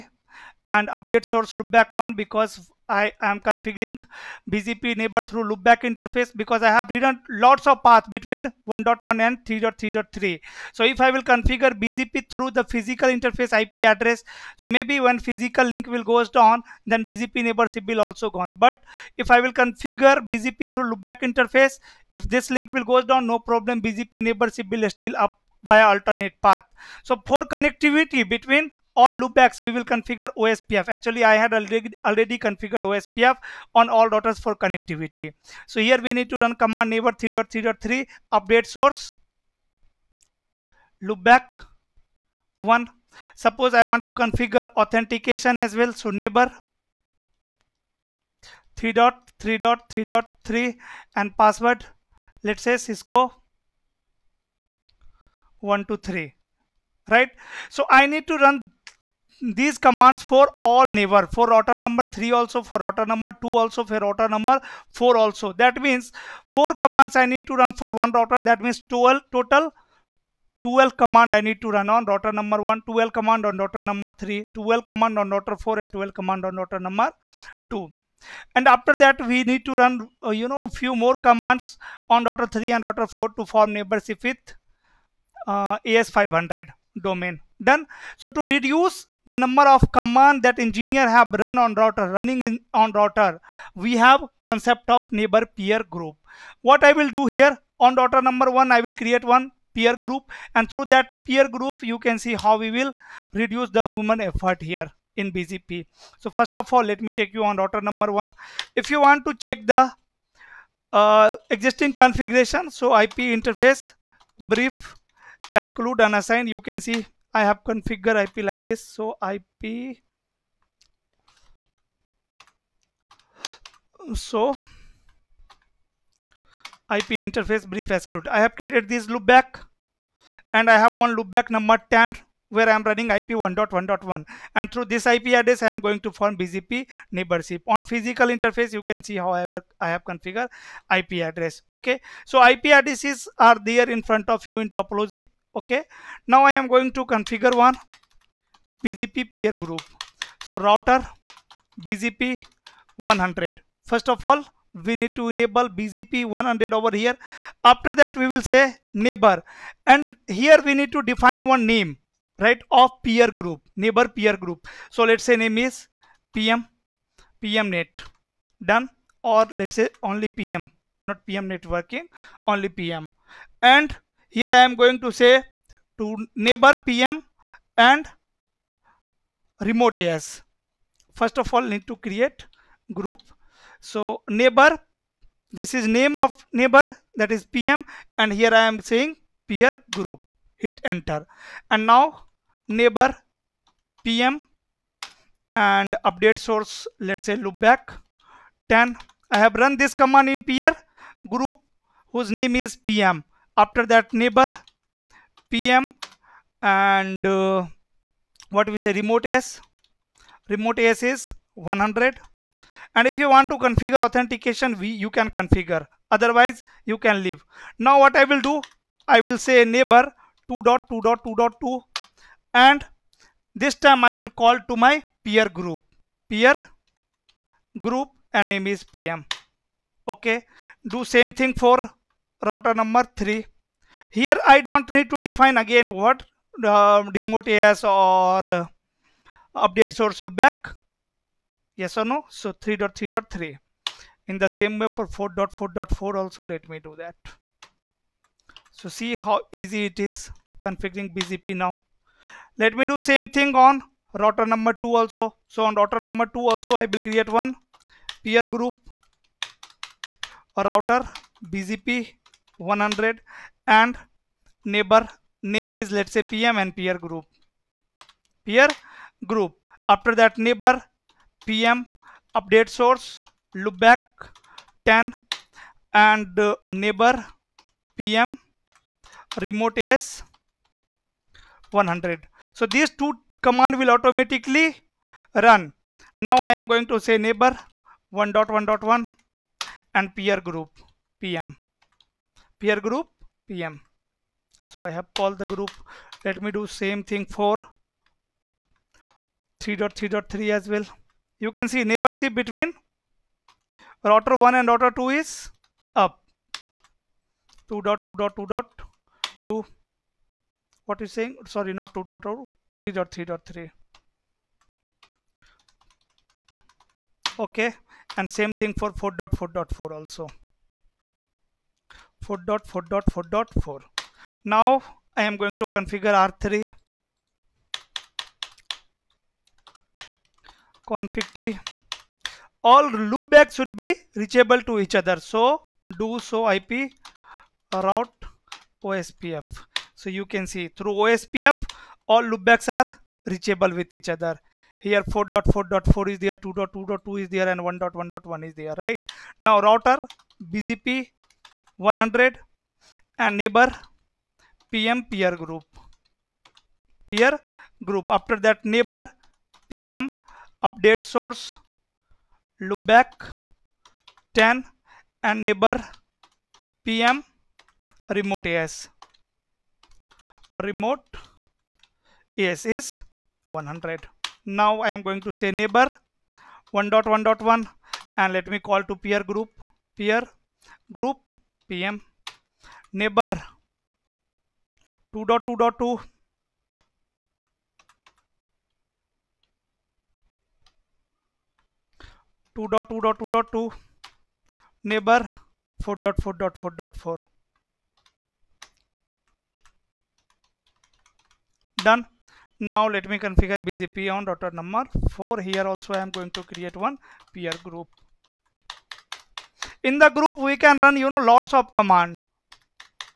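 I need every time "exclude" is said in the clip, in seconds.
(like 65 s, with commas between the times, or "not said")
115 s, 127 s.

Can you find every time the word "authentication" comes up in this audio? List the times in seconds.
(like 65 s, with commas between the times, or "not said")
44 s, 214 s.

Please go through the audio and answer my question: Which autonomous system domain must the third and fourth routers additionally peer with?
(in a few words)
AS500.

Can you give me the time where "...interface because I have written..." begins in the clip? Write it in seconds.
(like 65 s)
5 s.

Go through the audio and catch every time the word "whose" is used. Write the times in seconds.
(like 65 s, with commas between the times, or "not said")
202 s.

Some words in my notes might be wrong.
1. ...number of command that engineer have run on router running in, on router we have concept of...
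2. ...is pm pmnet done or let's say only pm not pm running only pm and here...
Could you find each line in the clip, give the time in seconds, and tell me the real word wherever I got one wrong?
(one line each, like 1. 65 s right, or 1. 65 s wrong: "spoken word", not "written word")
1. 89 s right
2. 165 s wrong: "networking", not "running".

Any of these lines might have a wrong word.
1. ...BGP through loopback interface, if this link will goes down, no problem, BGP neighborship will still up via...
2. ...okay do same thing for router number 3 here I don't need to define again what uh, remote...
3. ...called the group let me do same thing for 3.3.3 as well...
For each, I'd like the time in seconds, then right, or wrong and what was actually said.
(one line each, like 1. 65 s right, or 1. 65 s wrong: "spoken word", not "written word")
1. 20 s right
2. 230 s right
3. 295 s right.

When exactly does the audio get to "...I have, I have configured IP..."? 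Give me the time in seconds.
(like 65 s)
139 s.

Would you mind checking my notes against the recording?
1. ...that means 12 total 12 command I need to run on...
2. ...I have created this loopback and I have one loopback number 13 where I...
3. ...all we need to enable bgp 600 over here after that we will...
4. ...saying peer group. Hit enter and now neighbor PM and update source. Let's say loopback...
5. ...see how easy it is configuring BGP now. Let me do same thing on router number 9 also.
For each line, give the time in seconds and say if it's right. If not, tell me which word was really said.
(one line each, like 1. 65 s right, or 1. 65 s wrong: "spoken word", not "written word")
1. 68 s right
2. 128 s wrong: "10", not "13"
3. 154 s wrong: "100", not "600"
4. 188 s right
5. 248 s wrong: "2", not "9".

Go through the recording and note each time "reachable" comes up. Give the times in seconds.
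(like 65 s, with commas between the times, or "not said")
334 s, 343 s.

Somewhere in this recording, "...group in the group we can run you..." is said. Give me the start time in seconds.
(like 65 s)
407 s.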